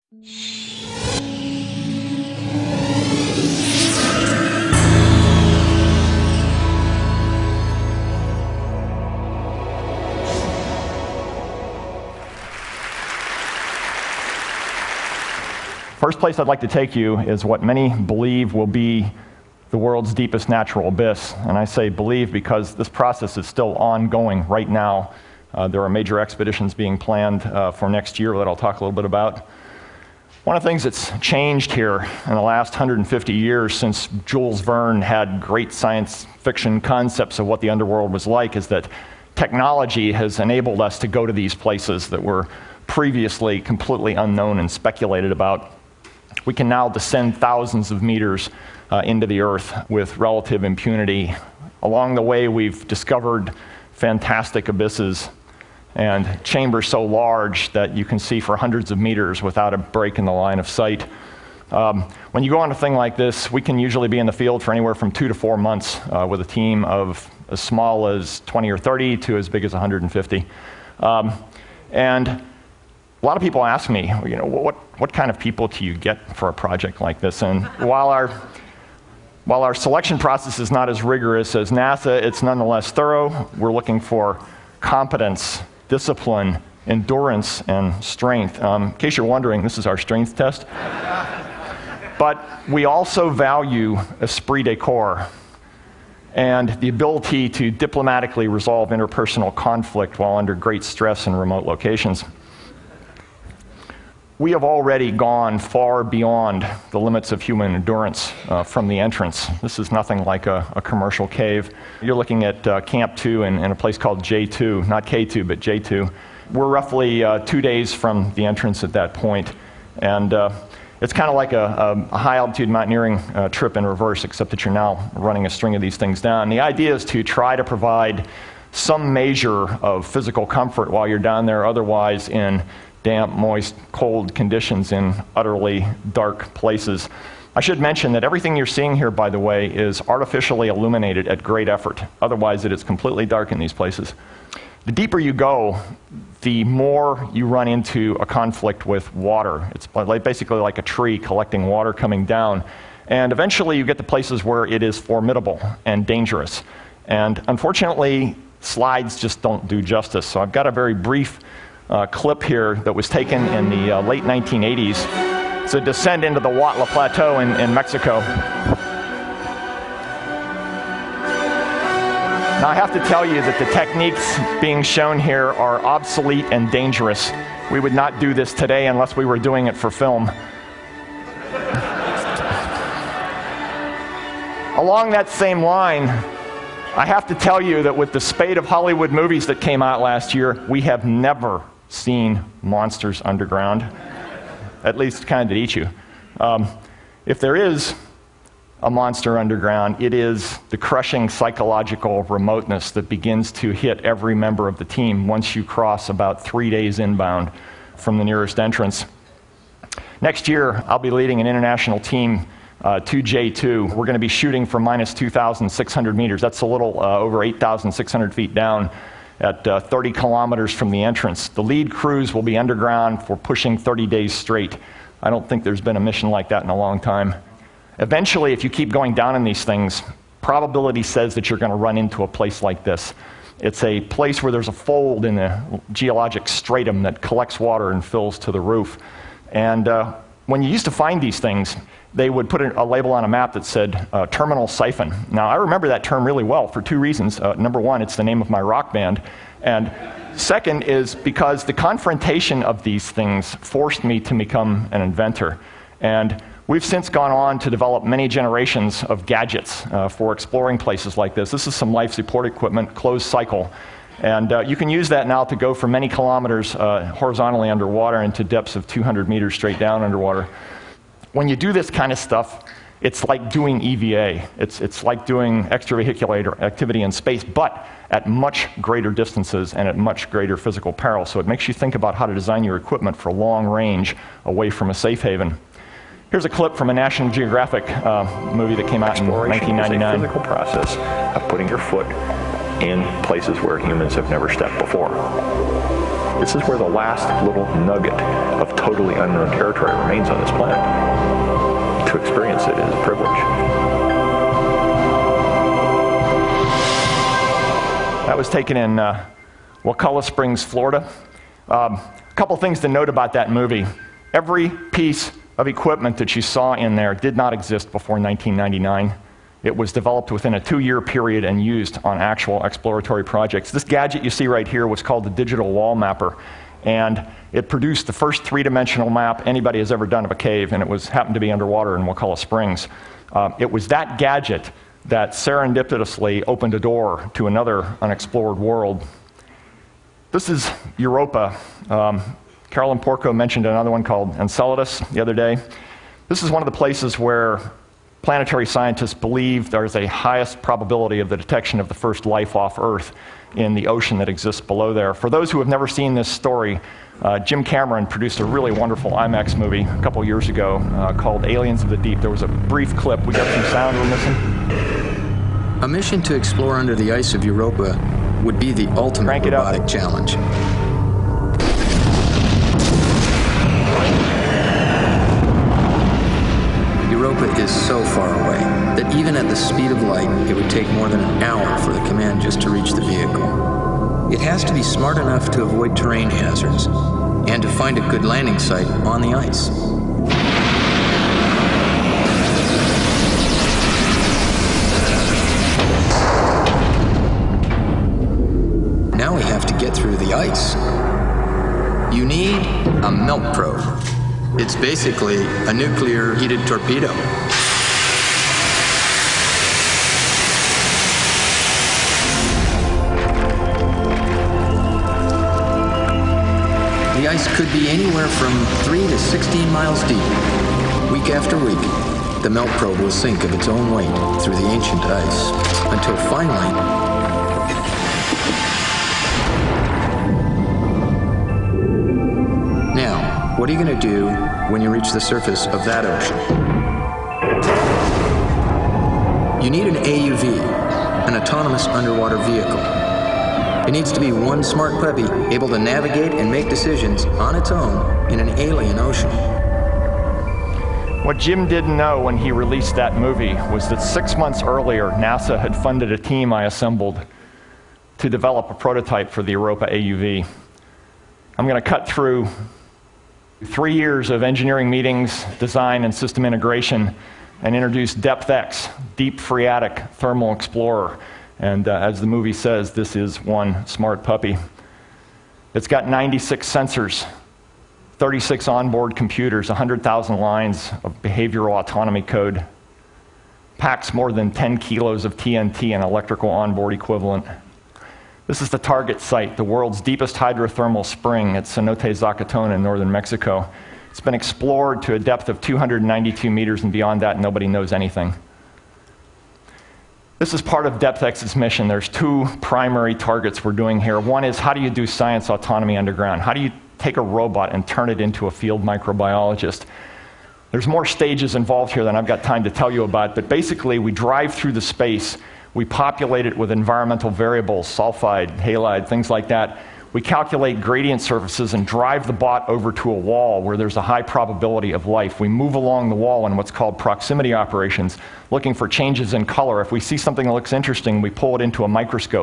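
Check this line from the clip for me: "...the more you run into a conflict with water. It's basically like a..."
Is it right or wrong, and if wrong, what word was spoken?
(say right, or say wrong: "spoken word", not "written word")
right.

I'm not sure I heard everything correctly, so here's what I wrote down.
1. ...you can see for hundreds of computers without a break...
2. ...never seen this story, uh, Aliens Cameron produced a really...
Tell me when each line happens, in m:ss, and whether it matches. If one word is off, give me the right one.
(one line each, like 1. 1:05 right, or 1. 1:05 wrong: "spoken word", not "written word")
1. 0:57 wrong: "meters", not "computers"
2. 5:55 wrong: "Jim", not "Aliens".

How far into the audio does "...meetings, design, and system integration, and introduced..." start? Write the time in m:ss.
7:44.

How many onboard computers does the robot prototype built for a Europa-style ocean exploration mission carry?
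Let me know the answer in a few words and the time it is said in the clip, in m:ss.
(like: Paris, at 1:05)
36, at 7:58.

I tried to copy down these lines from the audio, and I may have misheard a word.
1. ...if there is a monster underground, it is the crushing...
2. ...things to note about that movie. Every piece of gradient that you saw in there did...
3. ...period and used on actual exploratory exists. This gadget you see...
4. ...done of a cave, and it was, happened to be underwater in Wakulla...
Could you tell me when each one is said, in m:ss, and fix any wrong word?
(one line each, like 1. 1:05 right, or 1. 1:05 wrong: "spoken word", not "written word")
1. 3:17 right
2. 5:12 wrong: "equipment", not "gradient"
3. 5:21 wrong: "projects", not "exists"
4. 5:30 right.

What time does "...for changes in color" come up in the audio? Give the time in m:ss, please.
8:48.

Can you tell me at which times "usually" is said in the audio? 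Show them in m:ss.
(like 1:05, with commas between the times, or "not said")
1:03.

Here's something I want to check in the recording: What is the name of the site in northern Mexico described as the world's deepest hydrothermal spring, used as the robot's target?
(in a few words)
Cenote Zacatona.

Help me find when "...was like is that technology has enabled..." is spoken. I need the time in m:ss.
0:38.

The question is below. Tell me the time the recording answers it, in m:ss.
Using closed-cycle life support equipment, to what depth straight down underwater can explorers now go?
4:28.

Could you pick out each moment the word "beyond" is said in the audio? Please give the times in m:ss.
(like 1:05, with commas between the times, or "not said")
1:46, 8:16.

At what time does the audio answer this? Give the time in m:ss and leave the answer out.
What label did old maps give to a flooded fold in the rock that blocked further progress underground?
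4:04.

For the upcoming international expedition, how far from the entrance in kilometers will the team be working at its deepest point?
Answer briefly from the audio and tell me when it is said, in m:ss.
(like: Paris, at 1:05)
30 kilometers, at 3:39.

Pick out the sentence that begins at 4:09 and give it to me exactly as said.
And second is because the confrontation of these things forced me to become an inventor.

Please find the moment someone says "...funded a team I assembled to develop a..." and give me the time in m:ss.
7:35.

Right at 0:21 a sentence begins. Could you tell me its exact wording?
And I say believe because this process is still ongoing right now.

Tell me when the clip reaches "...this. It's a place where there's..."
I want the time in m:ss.
3:52.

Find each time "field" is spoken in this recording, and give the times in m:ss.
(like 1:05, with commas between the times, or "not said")
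1:04, 8:28.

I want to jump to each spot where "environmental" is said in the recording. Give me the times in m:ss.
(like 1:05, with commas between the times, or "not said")
8:36.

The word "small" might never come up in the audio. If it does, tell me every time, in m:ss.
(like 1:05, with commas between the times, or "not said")
1:07.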